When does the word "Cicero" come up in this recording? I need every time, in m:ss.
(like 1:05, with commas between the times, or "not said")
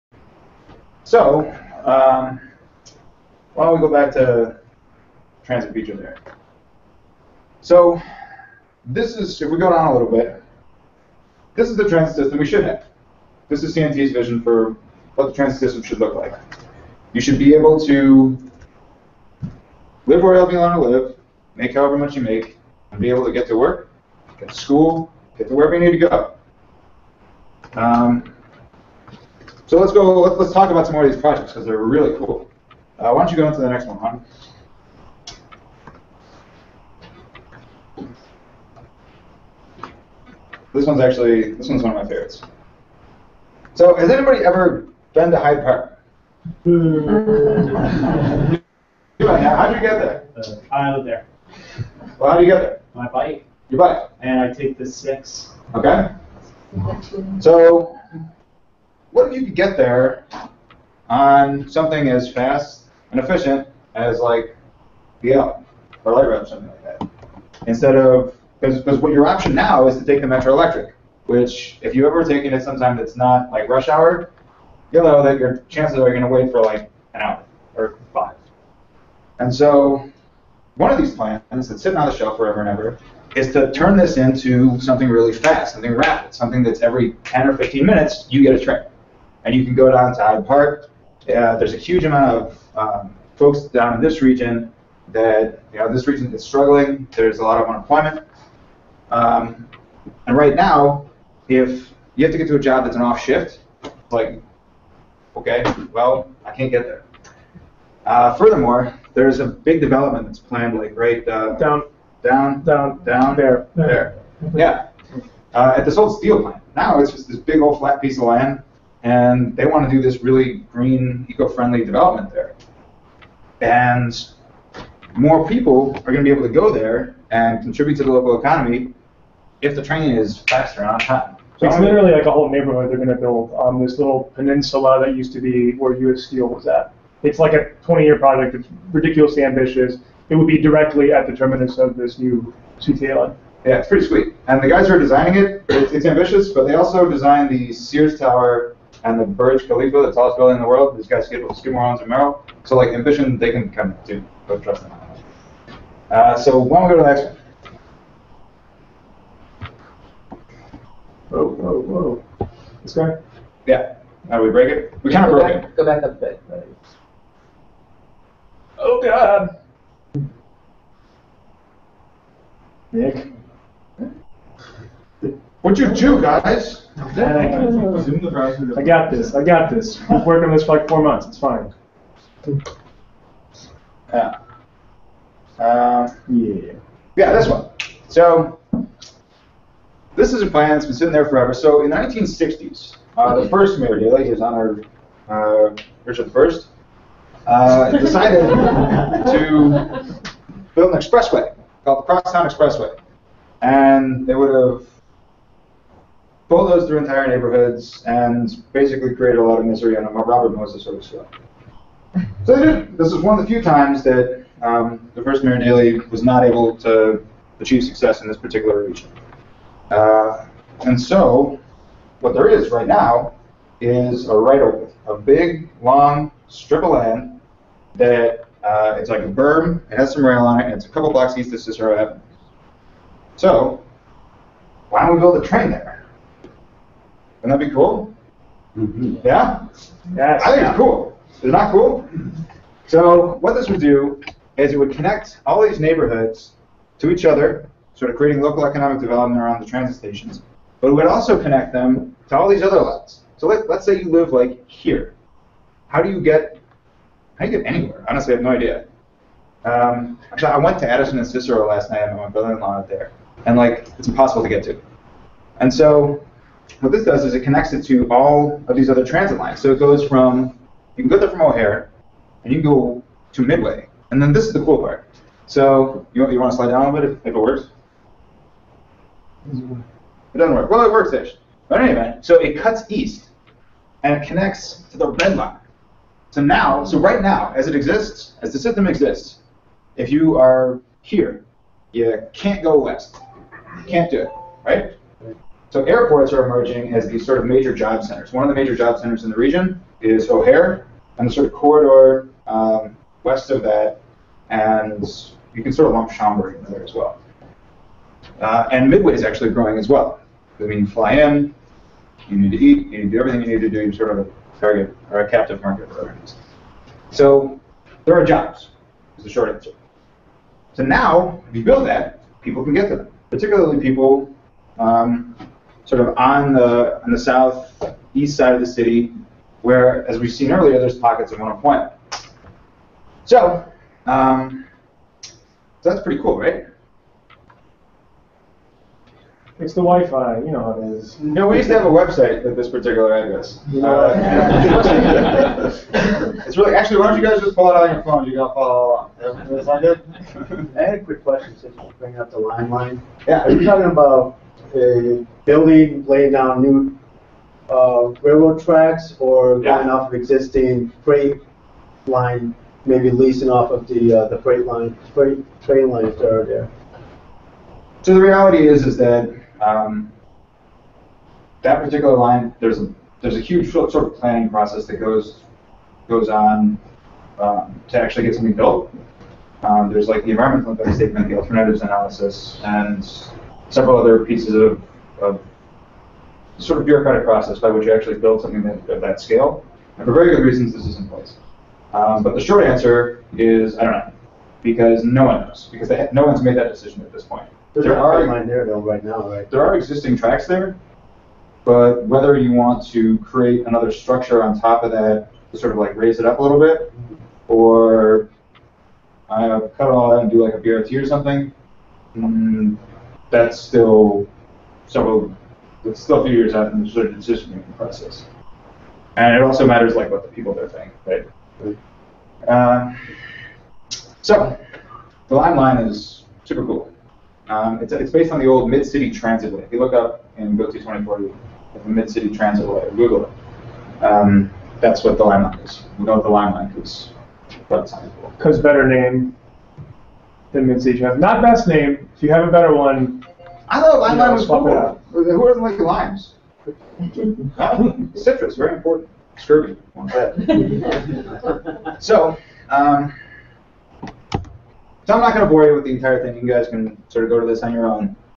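3:51, 4:21.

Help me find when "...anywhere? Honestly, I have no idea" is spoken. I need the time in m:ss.
4:17.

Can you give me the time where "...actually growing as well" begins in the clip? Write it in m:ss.
5:09.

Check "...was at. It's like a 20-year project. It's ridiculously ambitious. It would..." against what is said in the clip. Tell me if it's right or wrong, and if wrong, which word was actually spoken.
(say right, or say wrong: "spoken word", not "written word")
right.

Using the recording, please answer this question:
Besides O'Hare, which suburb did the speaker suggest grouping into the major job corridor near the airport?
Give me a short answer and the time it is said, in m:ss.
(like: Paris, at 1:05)
Schaumburg, at 5:06.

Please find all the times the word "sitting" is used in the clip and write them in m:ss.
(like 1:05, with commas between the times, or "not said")
1:21, 3:10.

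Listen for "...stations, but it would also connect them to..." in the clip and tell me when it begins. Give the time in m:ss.
4:09.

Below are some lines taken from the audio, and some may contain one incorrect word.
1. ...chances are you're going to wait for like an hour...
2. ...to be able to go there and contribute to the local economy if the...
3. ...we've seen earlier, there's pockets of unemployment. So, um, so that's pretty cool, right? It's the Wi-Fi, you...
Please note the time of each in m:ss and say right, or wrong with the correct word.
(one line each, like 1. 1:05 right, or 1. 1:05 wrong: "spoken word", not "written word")
1. 1:15 right
2. 2:06 right
3. 5:30 right.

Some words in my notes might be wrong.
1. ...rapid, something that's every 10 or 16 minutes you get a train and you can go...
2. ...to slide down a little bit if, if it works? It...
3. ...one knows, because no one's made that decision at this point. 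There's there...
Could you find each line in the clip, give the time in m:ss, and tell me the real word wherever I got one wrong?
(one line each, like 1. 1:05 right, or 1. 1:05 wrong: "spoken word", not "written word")
1. 1:25 wrong: "15", not "16"
2. 4:36 right
3. 6:35 right.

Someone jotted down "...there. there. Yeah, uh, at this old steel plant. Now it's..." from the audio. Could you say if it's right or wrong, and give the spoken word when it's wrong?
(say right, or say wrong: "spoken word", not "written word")
right.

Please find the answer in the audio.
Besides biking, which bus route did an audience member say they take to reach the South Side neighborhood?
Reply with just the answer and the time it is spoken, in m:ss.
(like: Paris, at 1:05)
6, at 0:54.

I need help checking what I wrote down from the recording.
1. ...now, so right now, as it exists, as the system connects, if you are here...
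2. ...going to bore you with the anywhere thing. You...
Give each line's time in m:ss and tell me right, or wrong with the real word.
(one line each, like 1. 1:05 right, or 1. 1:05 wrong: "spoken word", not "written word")
1. 4:46 wrong: "exists", not "connects"
2. 7:35 wrong: "entire", not "anywhere".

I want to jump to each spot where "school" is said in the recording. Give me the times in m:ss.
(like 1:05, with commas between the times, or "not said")
0:24.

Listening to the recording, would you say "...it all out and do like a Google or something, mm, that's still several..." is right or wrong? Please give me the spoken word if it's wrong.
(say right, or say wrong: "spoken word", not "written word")
wrong: "BRT", not "Google".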